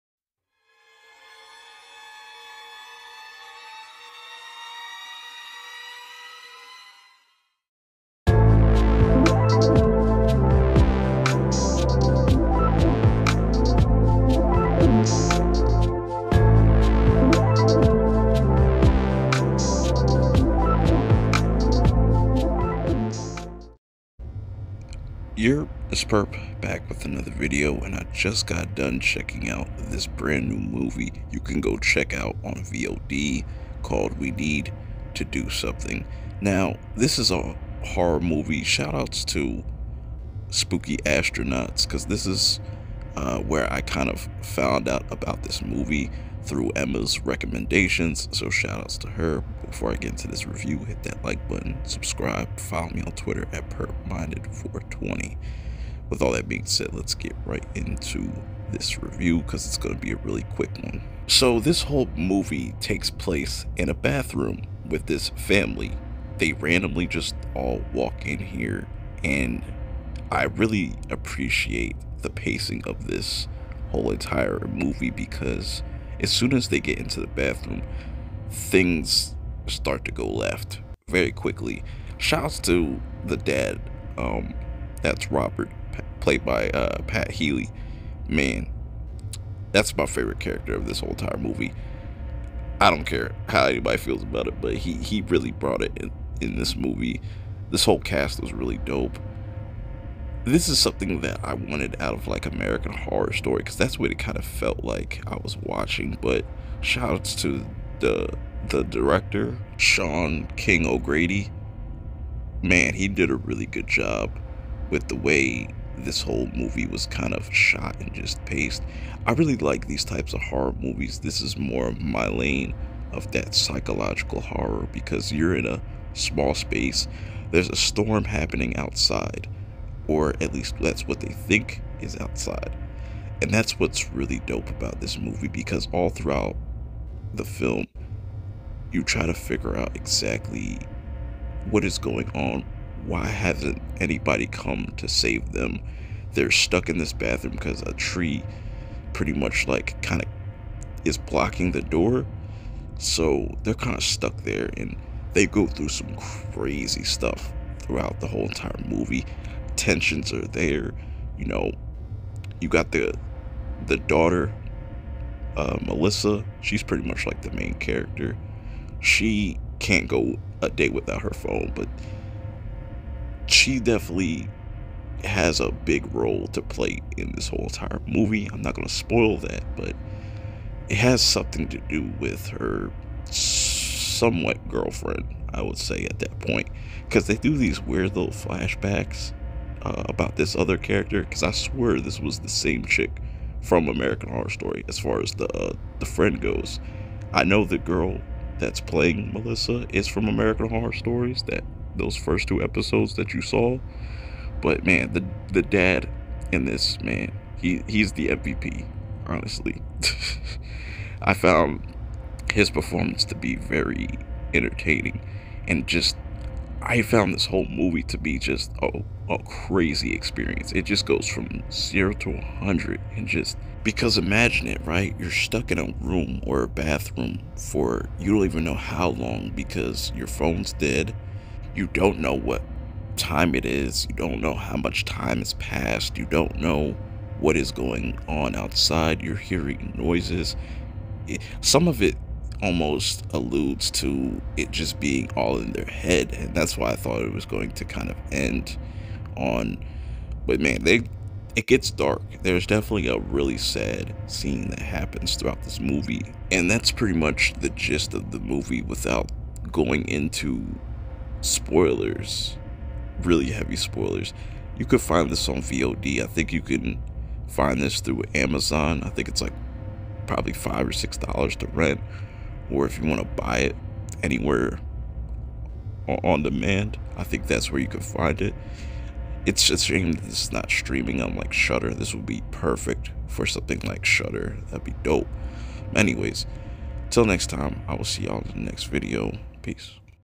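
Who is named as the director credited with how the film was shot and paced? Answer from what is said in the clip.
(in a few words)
Sean King O'Grady.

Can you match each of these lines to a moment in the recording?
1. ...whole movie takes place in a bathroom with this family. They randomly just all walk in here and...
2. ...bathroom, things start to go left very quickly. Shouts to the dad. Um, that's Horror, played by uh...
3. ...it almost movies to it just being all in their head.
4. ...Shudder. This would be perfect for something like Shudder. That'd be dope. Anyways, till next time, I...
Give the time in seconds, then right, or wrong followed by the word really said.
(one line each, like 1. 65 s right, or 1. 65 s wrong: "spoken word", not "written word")
1. 61 s right
2. 77 s wrong: "Robert", not "Horror"
3. 242 s wrong: "alludes", not "movies"
4. 281 s right.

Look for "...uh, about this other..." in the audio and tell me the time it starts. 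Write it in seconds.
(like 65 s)
189 s.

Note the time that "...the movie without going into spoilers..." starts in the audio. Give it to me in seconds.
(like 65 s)
258 s.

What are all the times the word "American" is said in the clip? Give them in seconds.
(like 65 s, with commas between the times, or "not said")
102 s, 193 s, 200 s.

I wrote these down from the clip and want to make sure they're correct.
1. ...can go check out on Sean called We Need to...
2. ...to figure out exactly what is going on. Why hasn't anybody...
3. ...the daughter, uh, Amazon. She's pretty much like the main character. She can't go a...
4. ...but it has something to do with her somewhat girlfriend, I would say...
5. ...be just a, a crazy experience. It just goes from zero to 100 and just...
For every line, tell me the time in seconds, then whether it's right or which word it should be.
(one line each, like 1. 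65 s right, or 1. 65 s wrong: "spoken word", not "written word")
1. 31 s wrong: "VOD", not "Sean"
2. 139 s right
3. 163 s wrong: "Melissa", not "Amazon"
4. 179 s right
5. 218 s right.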